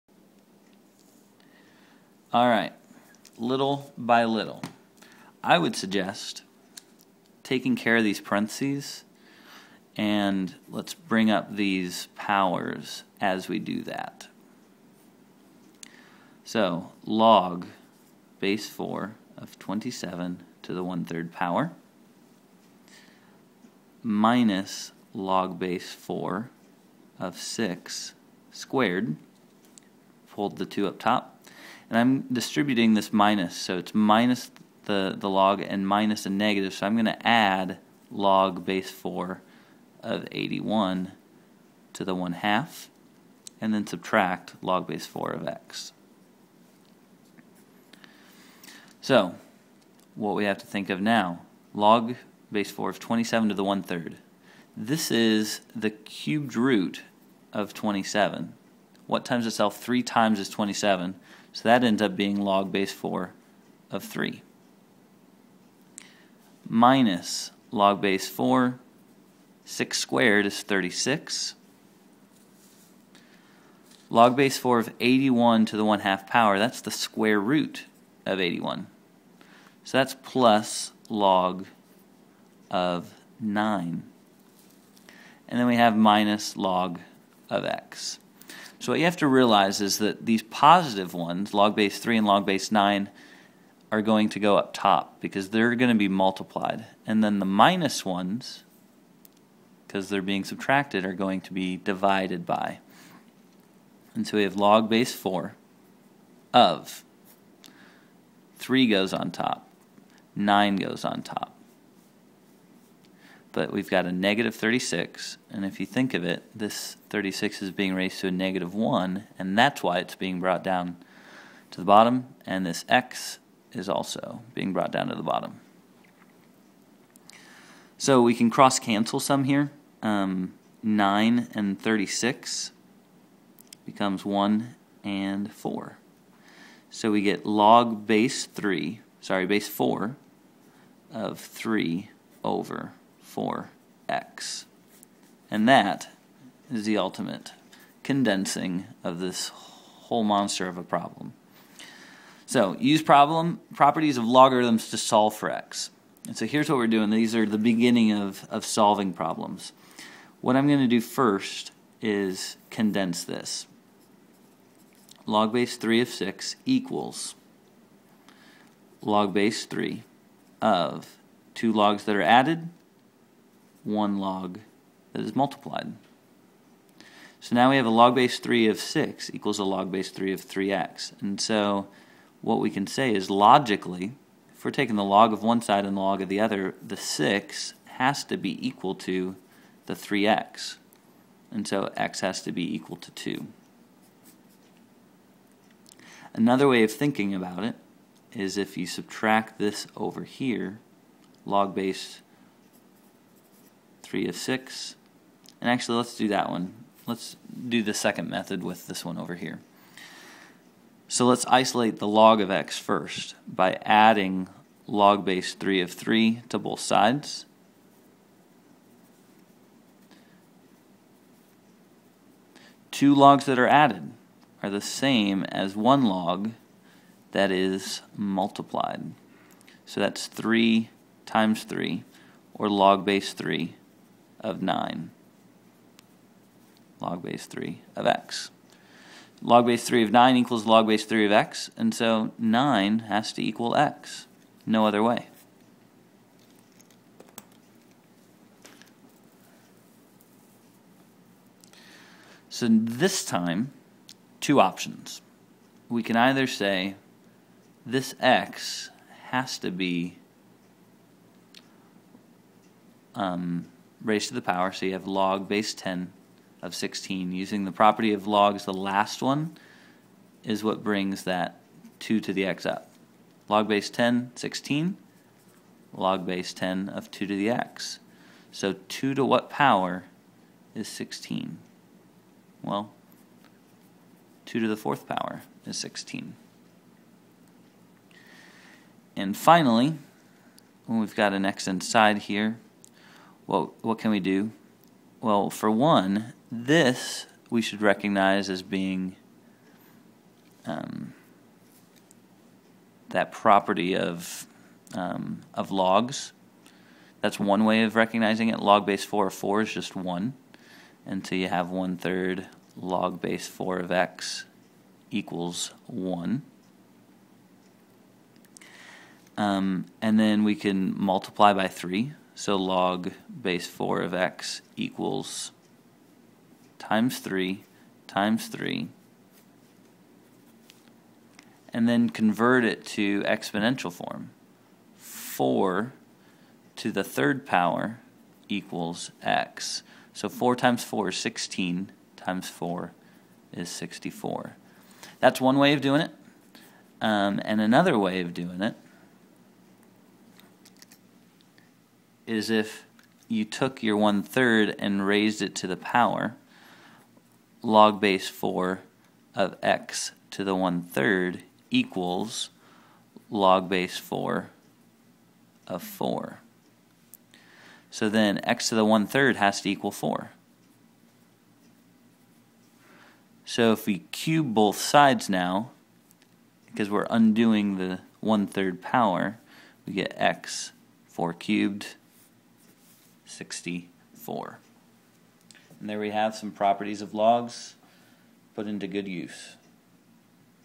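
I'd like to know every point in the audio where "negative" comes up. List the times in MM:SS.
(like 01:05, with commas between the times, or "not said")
00:36, 01:54, 01:58.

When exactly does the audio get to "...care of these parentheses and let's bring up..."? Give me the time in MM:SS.
00:07.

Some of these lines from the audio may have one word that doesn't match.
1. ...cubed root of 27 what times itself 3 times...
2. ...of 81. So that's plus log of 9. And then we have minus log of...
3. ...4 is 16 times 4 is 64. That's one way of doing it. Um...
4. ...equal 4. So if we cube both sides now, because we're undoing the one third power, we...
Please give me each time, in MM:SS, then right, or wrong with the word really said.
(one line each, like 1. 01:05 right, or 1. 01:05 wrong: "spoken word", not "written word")
1. 00:55 right
2. 01:18 right
3. 05:40 right
4. 06:09 right.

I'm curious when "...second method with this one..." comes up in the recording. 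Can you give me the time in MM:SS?
03:27.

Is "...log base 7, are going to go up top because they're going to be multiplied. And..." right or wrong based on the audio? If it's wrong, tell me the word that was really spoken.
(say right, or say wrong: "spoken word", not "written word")
wrong: "9", not "7".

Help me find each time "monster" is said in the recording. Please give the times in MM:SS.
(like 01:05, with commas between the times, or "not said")
02:30.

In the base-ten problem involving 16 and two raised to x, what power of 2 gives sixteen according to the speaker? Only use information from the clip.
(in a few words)
fourth power.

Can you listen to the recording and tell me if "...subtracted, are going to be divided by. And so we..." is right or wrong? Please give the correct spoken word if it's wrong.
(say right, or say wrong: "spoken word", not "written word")
right.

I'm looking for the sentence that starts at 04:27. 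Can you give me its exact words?
Using the property of logs, the last one is what brings that 2 to the x up.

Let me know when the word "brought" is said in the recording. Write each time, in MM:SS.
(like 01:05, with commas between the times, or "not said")
02:00, 02:04.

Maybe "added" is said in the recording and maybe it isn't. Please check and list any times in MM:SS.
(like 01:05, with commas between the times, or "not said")
02:52, 03:43.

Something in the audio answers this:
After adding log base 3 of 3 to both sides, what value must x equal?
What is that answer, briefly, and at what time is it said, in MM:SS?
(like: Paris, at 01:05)
9, at 04:02.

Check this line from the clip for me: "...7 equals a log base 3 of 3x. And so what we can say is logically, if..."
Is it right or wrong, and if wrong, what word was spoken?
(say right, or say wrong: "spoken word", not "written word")
wrong: "6", not "7".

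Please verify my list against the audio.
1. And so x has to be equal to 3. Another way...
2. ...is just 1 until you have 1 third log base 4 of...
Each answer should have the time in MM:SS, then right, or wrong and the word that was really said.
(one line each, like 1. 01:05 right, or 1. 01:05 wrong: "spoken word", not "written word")
1. 03:11 wrong: "2", not "3"
2. 05:09 right.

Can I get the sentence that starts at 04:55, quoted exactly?
Well, for one, this we should recognize as being um, that property of um, of logs.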